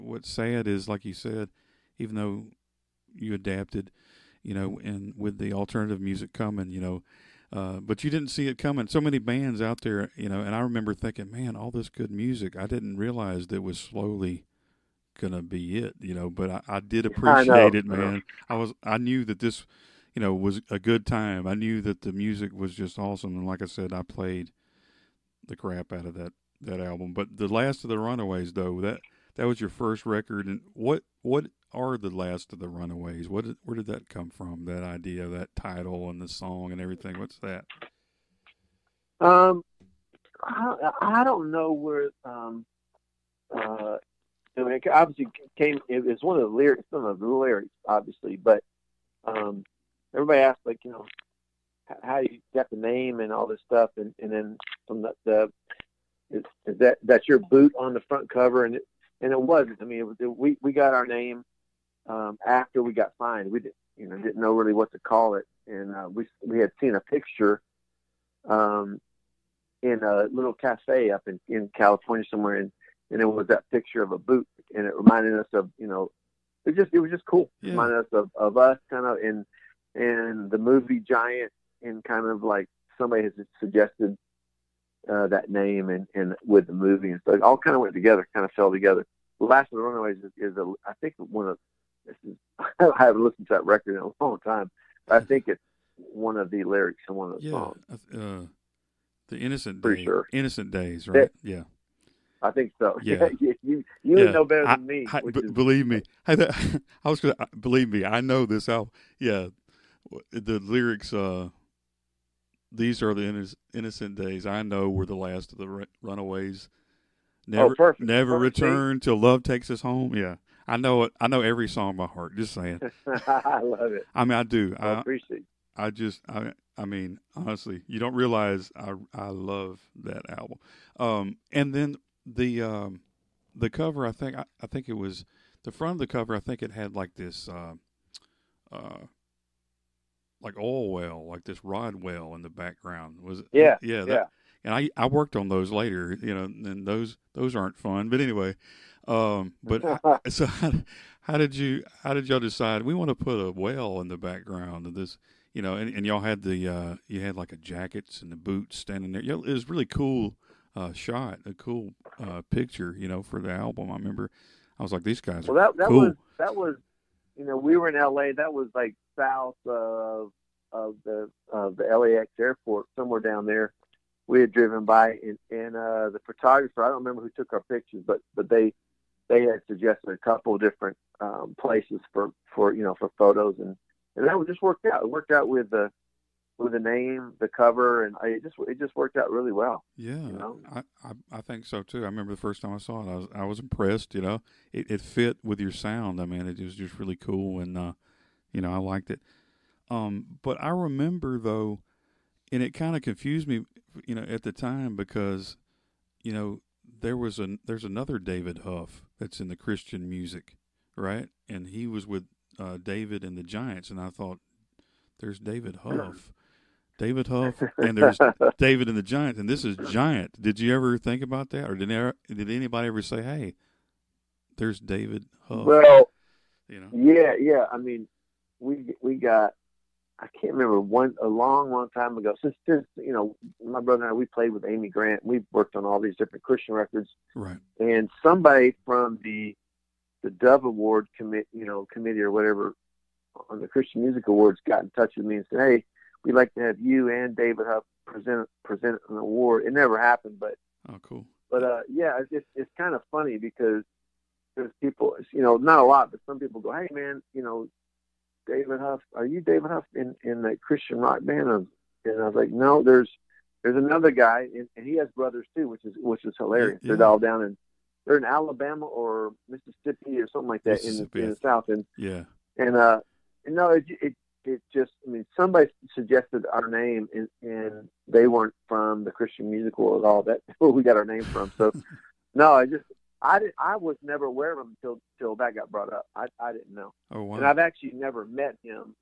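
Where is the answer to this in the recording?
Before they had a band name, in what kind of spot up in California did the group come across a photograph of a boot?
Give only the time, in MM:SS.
01:10.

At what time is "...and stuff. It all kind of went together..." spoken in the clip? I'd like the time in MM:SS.
01:27.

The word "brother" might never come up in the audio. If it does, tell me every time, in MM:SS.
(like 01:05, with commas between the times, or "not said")
03:53, 04:25.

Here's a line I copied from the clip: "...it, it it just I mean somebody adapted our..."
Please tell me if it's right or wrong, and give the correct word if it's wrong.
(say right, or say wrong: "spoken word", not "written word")
wrong: "suggested", not "adapted".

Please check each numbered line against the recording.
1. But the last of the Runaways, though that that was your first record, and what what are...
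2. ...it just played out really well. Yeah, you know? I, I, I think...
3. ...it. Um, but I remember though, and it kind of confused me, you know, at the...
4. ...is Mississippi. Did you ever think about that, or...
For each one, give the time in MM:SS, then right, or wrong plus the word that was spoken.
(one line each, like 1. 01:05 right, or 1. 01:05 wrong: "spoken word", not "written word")
1. 00:27 right
2. 03:08 wrong: "worked", not "played"
3. 03:19 right
4. 03:39 wrong: "Giant", not "Mississippi".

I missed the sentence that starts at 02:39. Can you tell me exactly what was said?
It was really cool uh, shot, a cool uh, picture, you know, for the album.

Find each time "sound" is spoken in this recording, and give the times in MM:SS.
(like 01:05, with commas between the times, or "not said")
03:15.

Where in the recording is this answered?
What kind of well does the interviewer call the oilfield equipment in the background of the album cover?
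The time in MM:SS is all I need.
02:21.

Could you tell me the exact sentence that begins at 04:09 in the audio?
It never happened, but oh, cool.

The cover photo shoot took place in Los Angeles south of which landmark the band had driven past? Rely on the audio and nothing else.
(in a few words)
LAX airport.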